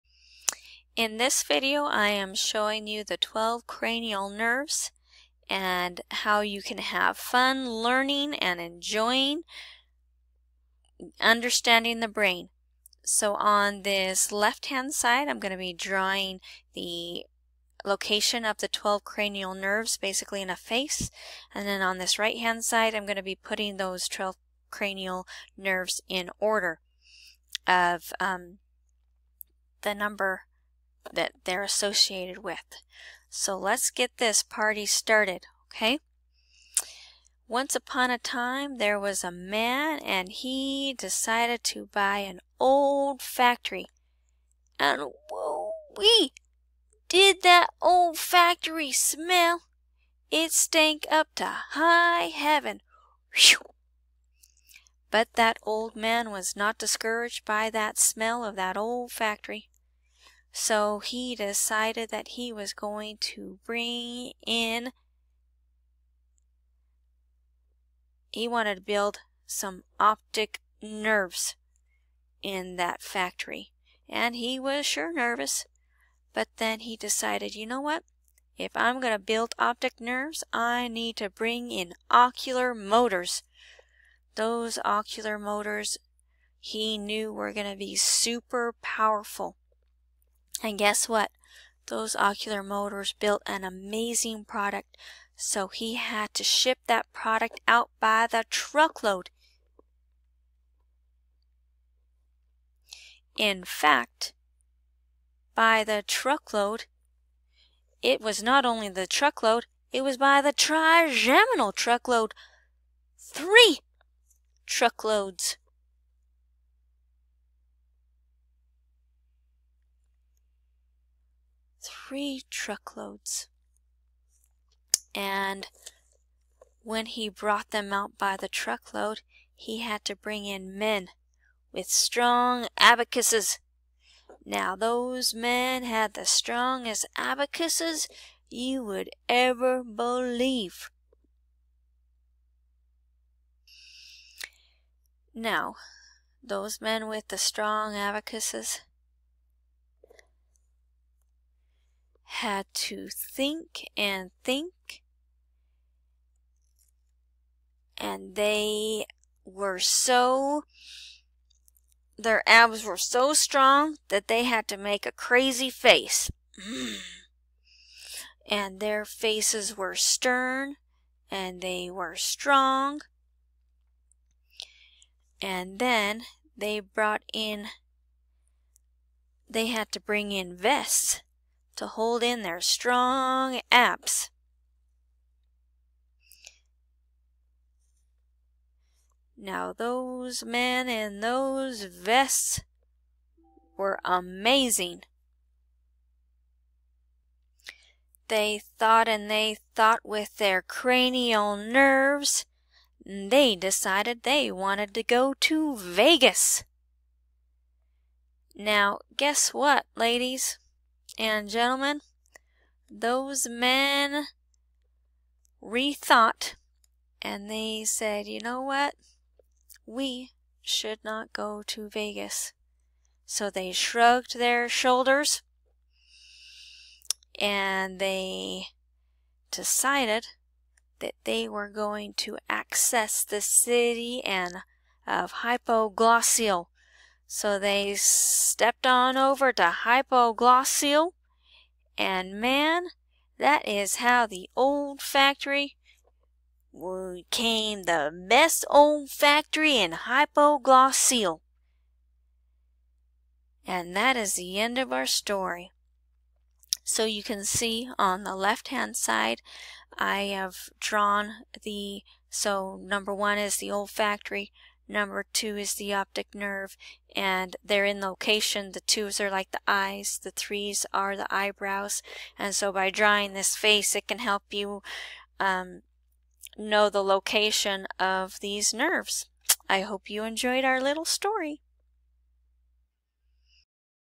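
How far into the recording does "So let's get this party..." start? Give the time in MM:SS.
00:33.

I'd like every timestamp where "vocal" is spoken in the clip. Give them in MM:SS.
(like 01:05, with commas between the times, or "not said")
not said.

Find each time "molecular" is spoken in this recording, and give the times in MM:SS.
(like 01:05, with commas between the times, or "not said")
not said.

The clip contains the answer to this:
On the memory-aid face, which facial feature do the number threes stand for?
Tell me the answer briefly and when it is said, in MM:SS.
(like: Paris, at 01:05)
eyebrows, at 04:31.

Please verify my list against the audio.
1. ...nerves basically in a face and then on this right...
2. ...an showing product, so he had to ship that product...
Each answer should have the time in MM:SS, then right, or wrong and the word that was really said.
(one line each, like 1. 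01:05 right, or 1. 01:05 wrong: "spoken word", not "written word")
1. 00:19 right
2. 01:33 wrong: "amazing", not "showing".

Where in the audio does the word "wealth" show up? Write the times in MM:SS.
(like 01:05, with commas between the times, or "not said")
not said.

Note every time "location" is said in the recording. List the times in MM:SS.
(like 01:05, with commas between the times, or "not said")
00:17, 04:28, 04:37.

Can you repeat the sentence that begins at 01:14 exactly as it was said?
And he was sure nervous, but then he decided, you know what?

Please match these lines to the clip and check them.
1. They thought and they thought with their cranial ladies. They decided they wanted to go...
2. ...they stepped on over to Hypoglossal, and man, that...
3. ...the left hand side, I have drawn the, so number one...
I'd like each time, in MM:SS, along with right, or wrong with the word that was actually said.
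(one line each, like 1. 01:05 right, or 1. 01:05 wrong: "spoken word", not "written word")
1. 03:18 wrong: "nerves", not "ladies"
2. 03:57 right
3. 04:18 right.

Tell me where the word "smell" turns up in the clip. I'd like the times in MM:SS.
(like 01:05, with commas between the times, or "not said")
00:48, 00:57.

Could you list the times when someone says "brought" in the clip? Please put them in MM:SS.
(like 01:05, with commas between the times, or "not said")
02:07, 02:56.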